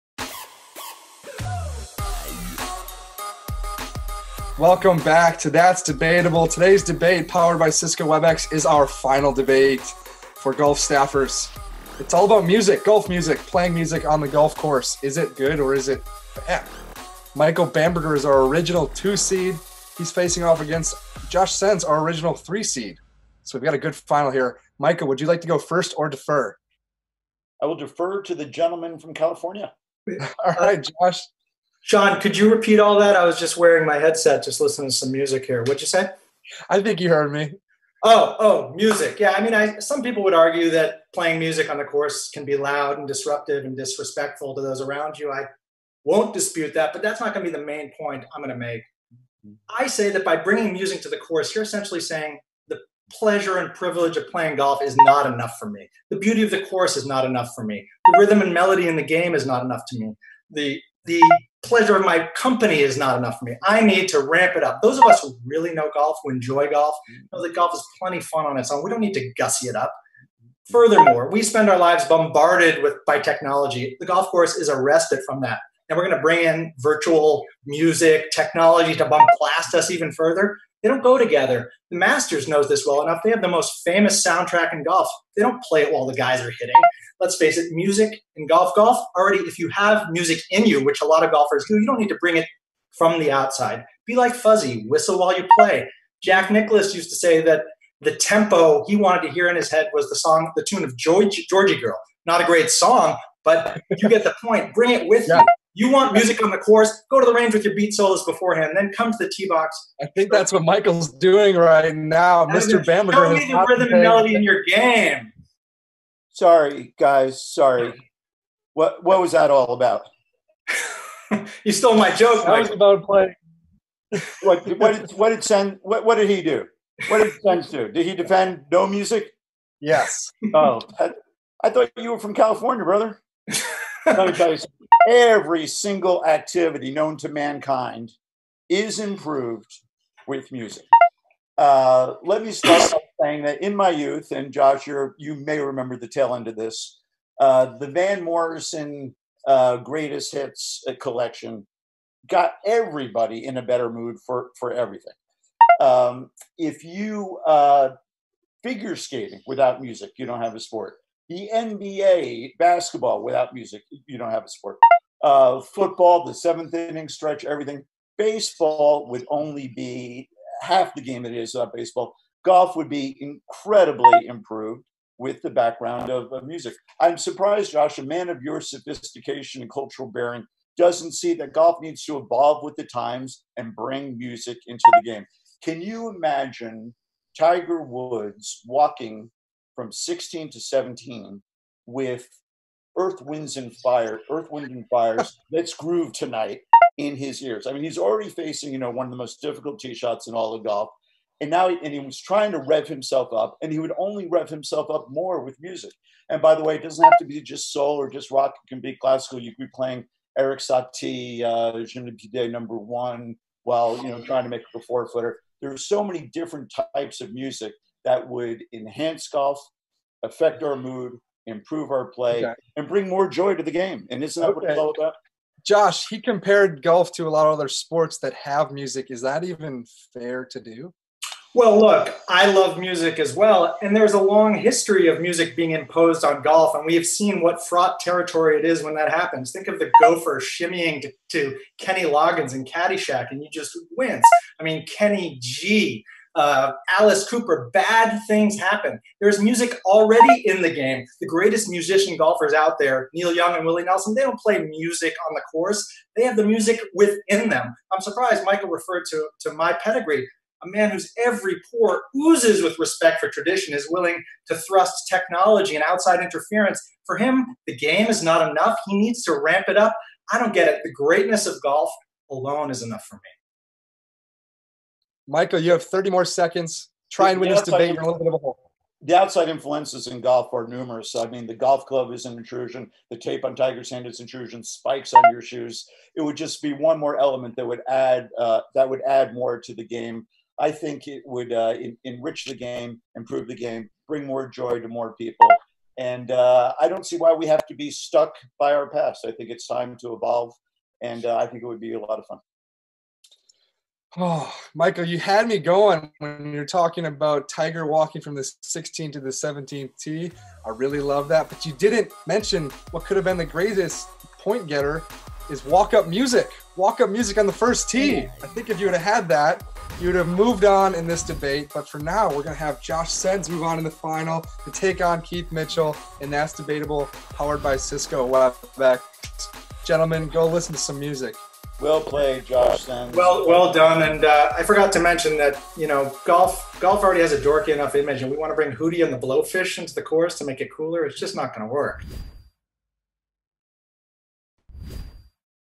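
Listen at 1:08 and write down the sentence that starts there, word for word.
We don't need to gussy it up.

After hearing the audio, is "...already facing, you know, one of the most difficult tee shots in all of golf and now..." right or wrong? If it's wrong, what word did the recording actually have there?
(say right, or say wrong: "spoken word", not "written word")
right.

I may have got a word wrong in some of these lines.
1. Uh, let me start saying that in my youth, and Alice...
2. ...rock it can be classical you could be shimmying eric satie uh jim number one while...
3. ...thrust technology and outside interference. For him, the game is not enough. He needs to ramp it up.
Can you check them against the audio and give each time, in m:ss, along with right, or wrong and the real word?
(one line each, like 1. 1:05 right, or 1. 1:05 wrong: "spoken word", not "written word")
1. 2:21 wrong: "Josh", not "Alice"
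2. 3:28 wrong: "playing", not "shimmying"
3. 4:24 right.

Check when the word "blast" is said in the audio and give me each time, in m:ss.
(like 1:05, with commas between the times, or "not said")
1:19.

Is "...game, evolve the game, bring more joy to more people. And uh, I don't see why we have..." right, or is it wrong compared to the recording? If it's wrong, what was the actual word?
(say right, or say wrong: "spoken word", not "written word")
wrong: "improve", not "evolve".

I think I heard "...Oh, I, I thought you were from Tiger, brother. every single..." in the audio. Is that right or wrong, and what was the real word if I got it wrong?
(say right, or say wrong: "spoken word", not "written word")
wrong: "California", not "Tiger".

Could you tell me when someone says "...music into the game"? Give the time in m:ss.
3:04.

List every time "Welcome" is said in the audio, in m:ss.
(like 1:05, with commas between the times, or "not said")
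0:04.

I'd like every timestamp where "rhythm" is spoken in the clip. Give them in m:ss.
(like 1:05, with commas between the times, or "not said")
0:58, 1:53.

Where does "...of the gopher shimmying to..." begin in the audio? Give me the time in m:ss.
3:59.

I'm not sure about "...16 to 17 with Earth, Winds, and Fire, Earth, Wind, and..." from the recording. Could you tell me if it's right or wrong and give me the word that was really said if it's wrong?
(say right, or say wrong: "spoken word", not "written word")
right.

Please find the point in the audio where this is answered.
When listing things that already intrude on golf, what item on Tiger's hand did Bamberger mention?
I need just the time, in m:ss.
4:43.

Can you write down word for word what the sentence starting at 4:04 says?
I mean, Kenny G, uh, Alice Cooper, bad things happen.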